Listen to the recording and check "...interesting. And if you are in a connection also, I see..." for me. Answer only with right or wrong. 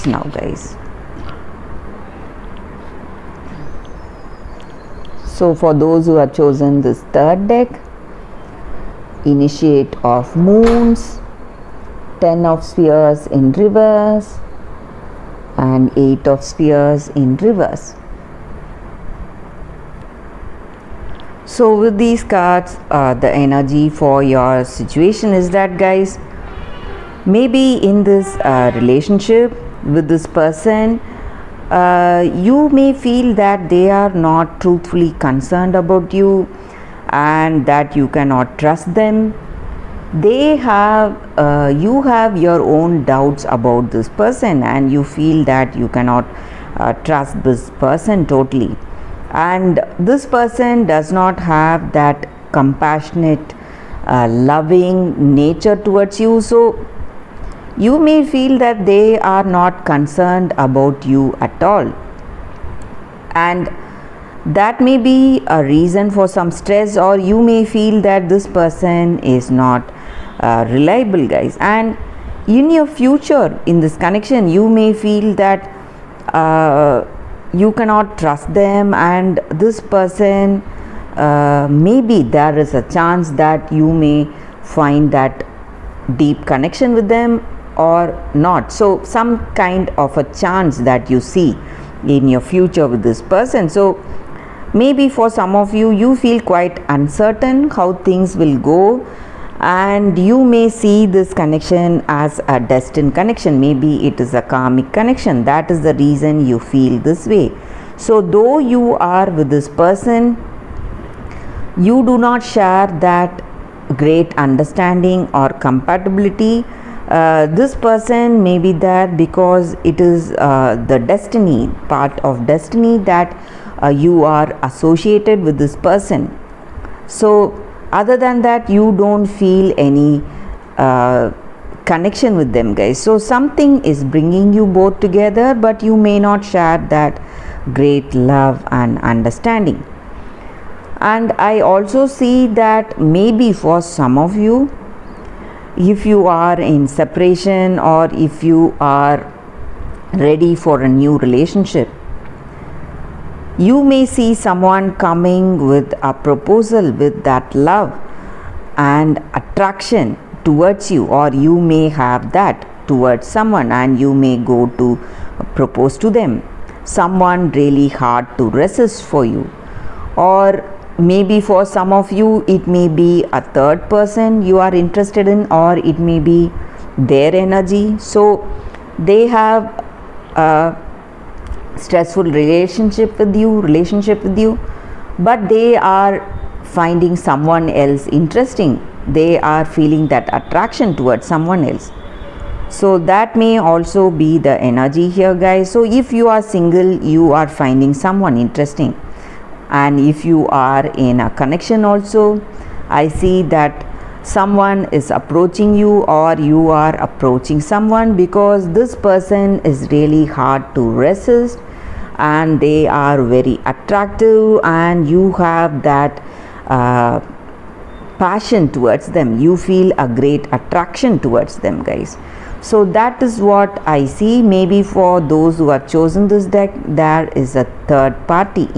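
right.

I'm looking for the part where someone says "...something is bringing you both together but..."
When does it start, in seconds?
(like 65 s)
133 s.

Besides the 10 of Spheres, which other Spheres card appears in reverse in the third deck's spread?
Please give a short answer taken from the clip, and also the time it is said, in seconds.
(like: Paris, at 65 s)
8 of Spheres, at 15 s.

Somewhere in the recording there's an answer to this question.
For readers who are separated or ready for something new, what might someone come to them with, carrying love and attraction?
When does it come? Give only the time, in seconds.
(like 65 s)
156 s.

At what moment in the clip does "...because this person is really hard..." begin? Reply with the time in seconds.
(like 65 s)
208 s.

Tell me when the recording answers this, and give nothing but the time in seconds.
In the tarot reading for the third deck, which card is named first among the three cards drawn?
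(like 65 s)
9 s.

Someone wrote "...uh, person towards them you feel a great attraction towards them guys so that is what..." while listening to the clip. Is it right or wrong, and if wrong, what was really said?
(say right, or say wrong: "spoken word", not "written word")
wrong: "passion", not "person".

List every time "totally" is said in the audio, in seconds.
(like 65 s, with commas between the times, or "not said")
48 s.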